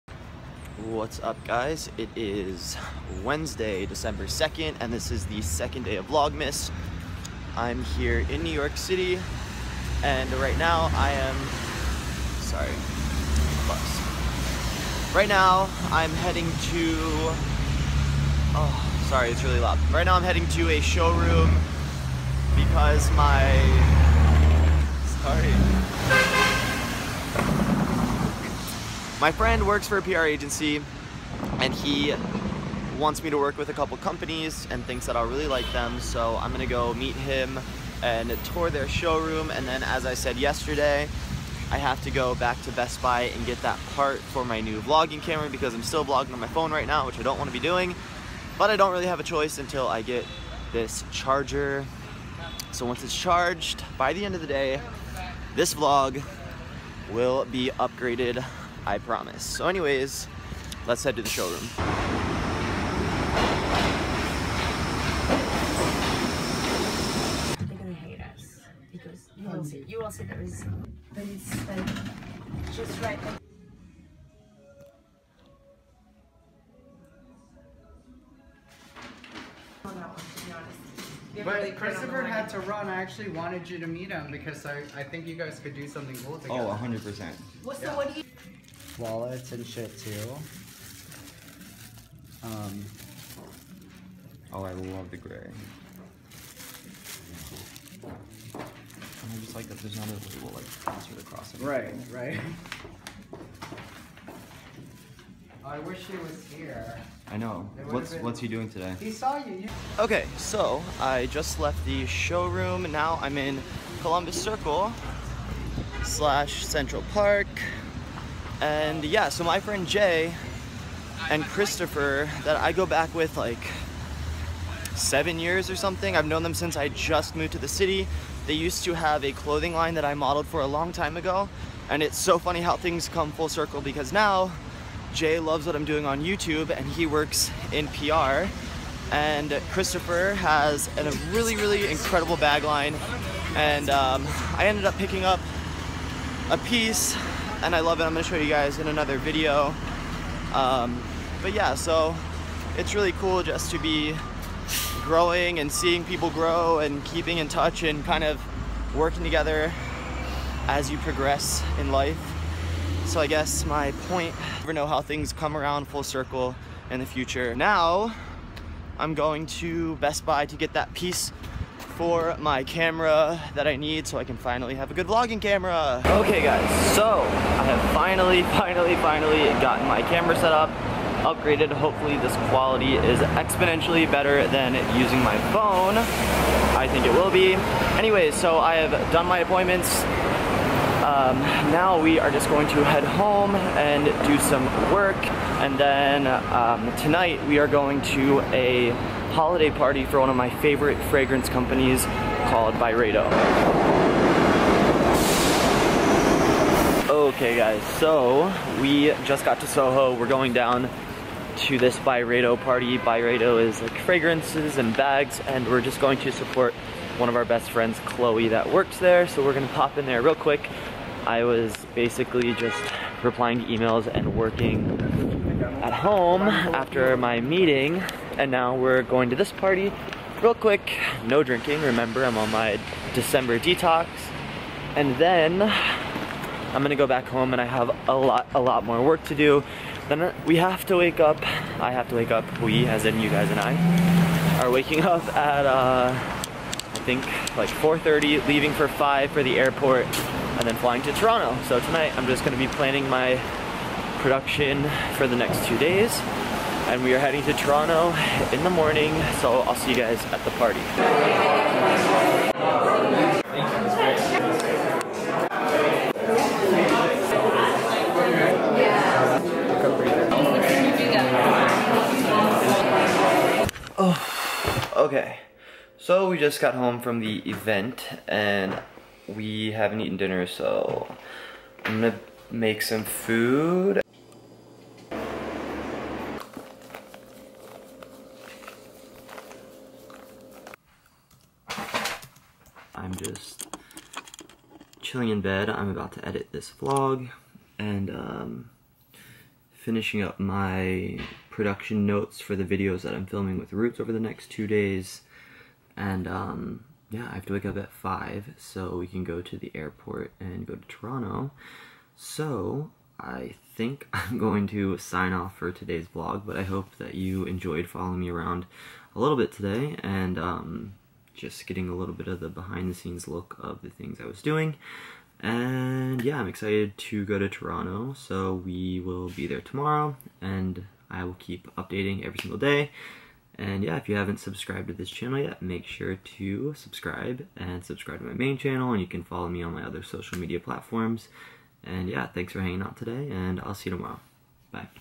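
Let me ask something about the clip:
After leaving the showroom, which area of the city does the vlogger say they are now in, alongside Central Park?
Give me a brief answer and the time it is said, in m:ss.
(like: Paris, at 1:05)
Columbus Circle, at 1:54.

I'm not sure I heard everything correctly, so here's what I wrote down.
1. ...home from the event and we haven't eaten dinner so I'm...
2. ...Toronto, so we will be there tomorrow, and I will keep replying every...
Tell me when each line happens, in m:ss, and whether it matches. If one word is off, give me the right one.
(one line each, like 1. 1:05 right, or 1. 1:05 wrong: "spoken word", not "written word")
1. 4:36 right
2. 5:27 wrong: "updating", not "replying".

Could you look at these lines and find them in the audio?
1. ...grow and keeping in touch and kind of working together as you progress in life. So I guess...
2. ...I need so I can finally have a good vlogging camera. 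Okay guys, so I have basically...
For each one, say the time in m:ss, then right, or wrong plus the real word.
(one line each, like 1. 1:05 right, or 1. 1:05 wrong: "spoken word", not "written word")
1. 2:36 right
2. 2:53 wrong: "finally", not "basically".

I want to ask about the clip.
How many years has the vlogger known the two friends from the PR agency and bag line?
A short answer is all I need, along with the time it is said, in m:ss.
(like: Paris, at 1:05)
7, at 2:04.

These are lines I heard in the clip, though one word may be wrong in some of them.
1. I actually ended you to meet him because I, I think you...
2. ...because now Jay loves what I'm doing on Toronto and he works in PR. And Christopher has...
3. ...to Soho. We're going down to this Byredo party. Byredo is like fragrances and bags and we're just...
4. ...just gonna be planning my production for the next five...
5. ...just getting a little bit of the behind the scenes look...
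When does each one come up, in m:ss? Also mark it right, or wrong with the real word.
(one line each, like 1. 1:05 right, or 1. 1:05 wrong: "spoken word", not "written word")
1. 1:22 wrong: "wanted", not "ended"
2. 2:13 wrong: "YouTube", not "Toronto"
3. 3:29 right
4. 4:12 wrong: "two", not "five"
5. 5:21 right.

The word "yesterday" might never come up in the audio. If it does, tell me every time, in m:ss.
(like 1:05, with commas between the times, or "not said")
0:40.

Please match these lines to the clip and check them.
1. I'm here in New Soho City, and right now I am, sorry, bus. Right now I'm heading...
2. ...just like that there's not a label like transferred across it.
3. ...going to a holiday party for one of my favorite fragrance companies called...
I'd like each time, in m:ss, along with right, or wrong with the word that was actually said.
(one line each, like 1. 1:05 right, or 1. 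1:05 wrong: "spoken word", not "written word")
1. 0:07 wrong: "York", not "Soho"
2. 1:39 right
3. 3:17 right.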